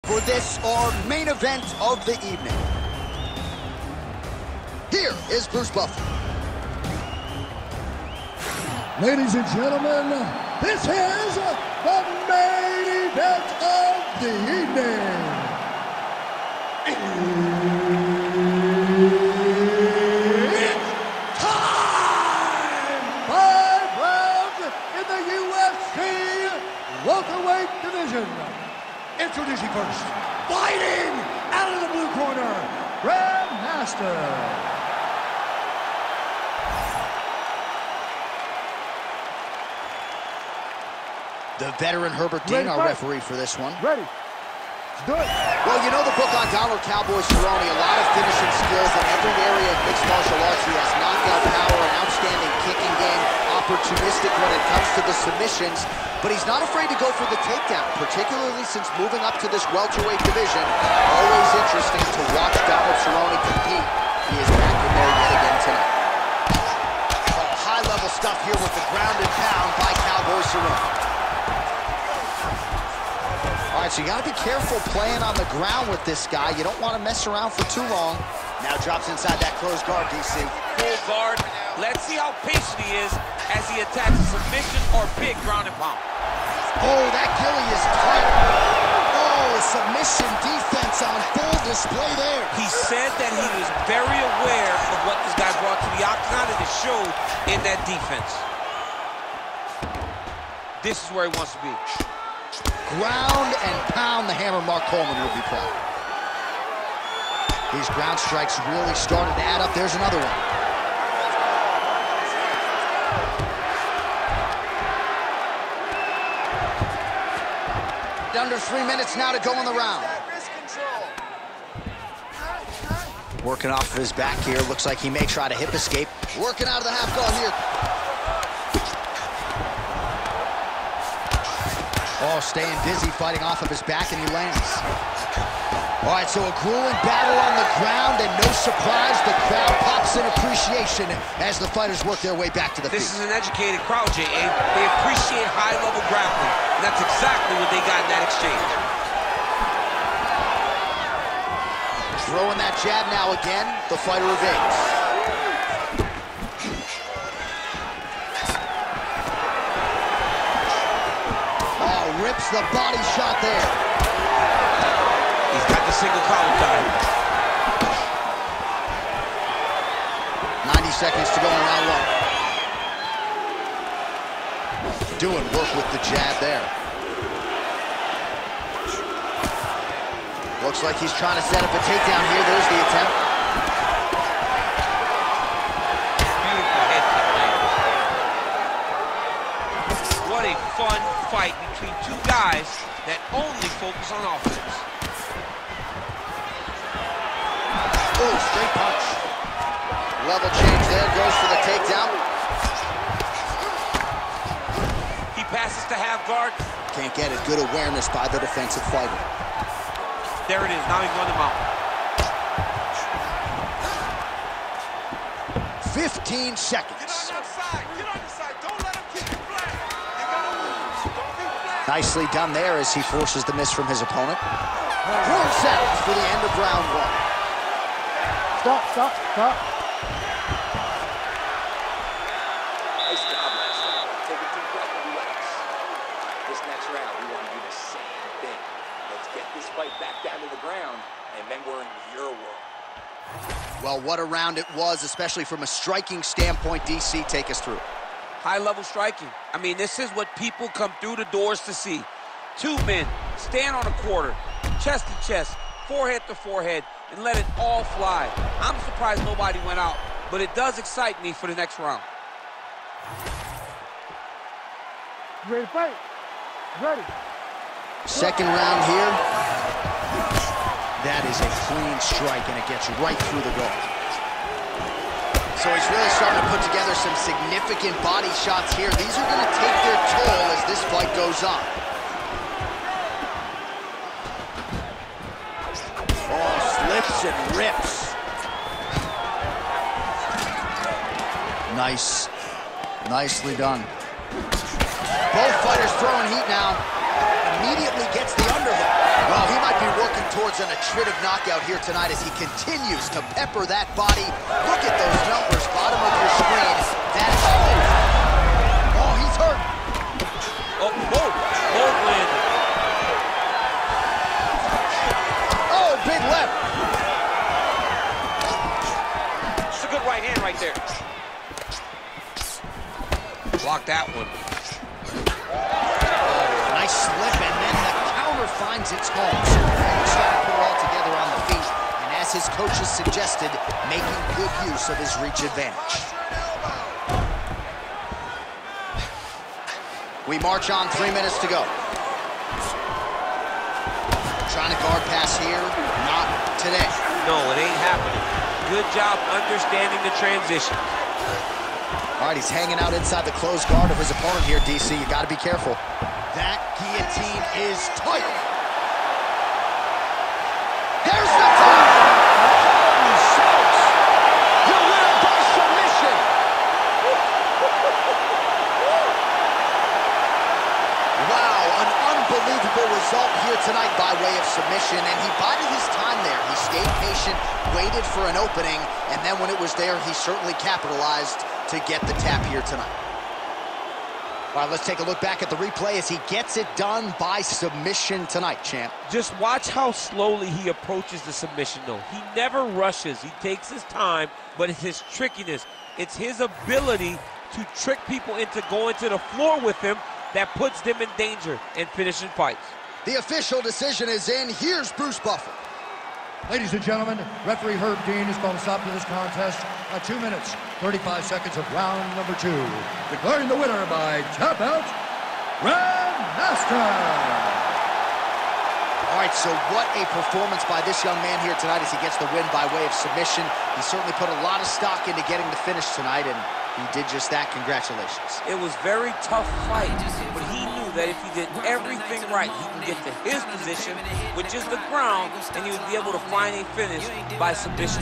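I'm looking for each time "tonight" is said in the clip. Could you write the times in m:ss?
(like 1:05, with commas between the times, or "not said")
1:05, 5:01, 6:13, 6:22, 6:28, 7:01, 7:05.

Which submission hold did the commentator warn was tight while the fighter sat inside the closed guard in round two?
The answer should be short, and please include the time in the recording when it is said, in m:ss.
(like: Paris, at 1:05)
Guillotine, at 5:56.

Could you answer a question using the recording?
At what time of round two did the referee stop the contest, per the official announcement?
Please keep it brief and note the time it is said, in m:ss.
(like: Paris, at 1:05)
2 minutes 35 seconds, at 6:50.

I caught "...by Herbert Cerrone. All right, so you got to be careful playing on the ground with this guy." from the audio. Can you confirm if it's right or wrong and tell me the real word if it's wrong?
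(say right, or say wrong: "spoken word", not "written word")
wrong: "Cowboy", not "Herbert".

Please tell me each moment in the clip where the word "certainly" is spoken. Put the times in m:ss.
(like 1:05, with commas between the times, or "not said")
6:20, 7:03.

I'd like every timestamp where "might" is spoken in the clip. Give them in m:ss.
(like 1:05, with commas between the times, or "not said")
4:59.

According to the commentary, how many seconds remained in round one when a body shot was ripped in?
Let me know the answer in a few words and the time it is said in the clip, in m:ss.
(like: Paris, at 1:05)
90, at 2:46.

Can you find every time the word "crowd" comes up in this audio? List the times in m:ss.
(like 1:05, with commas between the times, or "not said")
2:19, 2:23.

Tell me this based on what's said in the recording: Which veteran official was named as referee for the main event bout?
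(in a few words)
Herbert Dean.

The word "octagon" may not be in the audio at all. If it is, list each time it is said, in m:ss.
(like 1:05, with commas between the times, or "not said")
1:36.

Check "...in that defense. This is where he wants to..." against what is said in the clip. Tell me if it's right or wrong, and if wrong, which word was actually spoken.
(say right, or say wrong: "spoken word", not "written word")
right.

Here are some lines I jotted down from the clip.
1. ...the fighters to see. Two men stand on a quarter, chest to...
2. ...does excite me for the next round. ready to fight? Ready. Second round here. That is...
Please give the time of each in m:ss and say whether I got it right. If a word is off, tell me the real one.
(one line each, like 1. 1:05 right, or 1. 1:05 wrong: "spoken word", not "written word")
1. 4:11 wrong: "doors", not "fighters"
2. 4:20 right.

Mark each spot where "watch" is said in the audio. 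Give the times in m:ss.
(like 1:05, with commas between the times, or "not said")
1:02, 6:29.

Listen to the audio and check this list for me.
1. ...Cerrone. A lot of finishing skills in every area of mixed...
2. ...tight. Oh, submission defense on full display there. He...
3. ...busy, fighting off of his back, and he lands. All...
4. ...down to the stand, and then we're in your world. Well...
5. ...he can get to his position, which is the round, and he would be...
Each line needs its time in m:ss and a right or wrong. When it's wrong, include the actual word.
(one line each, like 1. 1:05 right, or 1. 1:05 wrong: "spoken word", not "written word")
1. 0:47 right
2. 1:27 right
3. 2:12 right
4. 4:00 wrong: "ground", not "stand"
5. 7:12 wrong: "ground", not "round".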